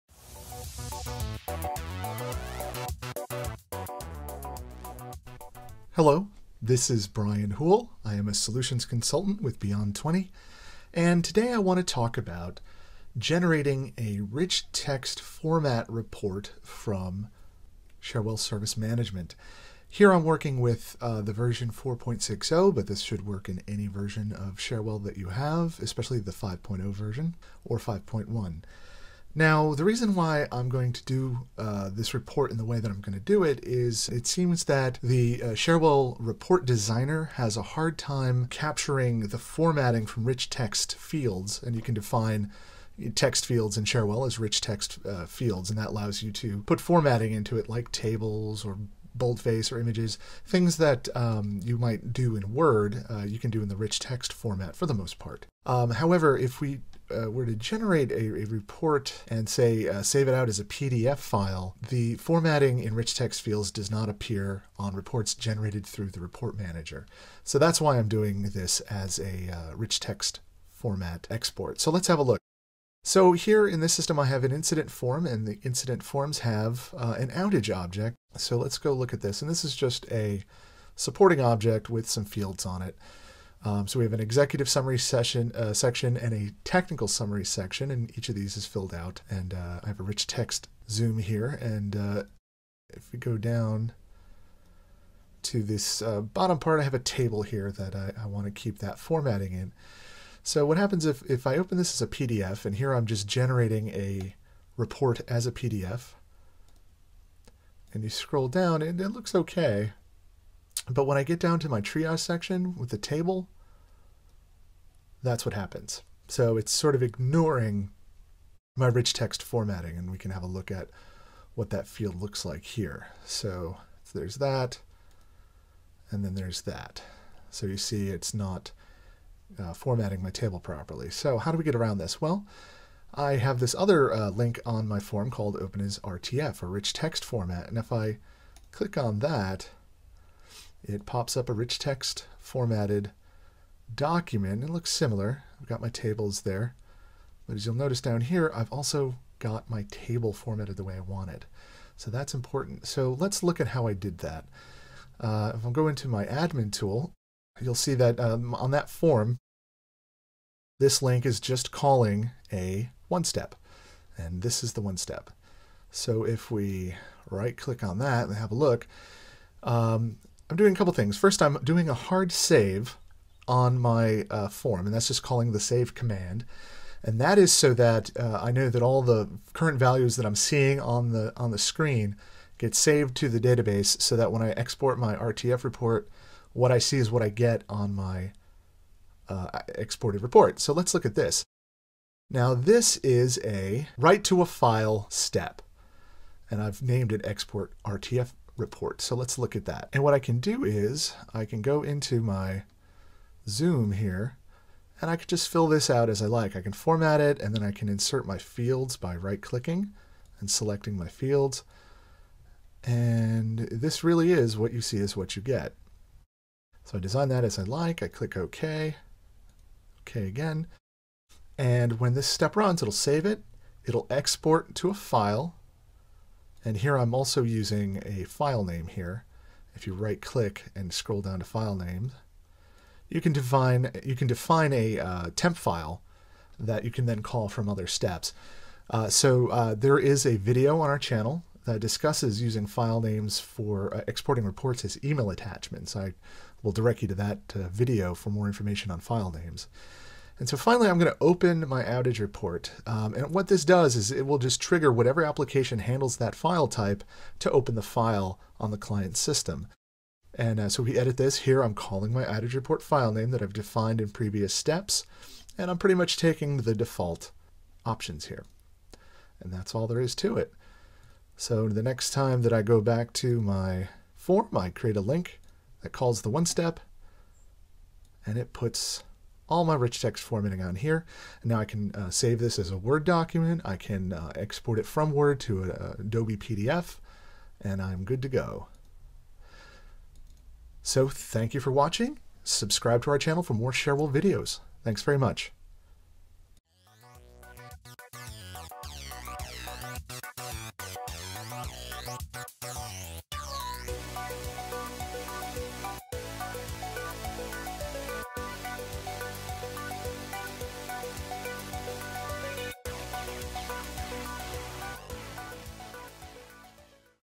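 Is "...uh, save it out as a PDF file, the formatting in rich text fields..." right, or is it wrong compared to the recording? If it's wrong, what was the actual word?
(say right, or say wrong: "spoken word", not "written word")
right.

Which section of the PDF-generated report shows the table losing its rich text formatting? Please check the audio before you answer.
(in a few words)
Triage section.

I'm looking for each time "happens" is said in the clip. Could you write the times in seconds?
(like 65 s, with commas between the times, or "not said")
100 s, 115 s.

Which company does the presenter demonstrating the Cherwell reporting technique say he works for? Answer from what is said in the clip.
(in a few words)
Beyond 20.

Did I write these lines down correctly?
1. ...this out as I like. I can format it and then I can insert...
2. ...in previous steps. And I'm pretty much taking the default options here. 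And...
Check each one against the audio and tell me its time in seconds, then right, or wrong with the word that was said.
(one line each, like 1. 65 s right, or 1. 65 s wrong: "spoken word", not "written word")
1. 205 s right
2. 264 s right.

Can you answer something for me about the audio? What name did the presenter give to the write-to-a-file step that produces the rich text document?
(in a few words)
Export RTF report.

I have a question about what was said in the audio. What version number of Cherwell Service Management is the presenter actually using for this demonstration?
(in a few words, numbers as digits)
4.60.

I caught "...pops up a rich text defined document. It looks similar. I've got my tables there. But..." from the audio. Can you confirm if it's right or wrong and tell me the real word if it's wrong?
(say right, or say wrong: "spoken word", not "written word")
wrong: "formatted", not "defined".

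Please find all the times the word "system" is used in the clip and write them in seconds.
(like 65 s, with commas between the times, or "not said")
73 s, 259 s.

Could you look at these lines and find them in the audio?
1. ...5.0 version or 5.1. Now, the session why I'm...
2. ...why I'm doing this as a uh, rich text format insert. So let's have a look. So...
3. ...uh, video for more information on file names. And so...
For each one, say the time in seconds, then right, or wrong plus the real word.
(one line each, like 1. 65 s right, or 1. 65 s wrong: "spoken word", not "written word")
1. 26 s wrong: "reason", not "session"
2. 67 s wrong: "export", not "insert"
3. 247 s right.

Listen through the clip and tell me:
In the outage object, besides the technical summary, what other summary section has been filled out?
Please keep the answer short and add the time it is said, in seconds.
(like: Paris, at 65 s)
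Executive summary, at 84 s.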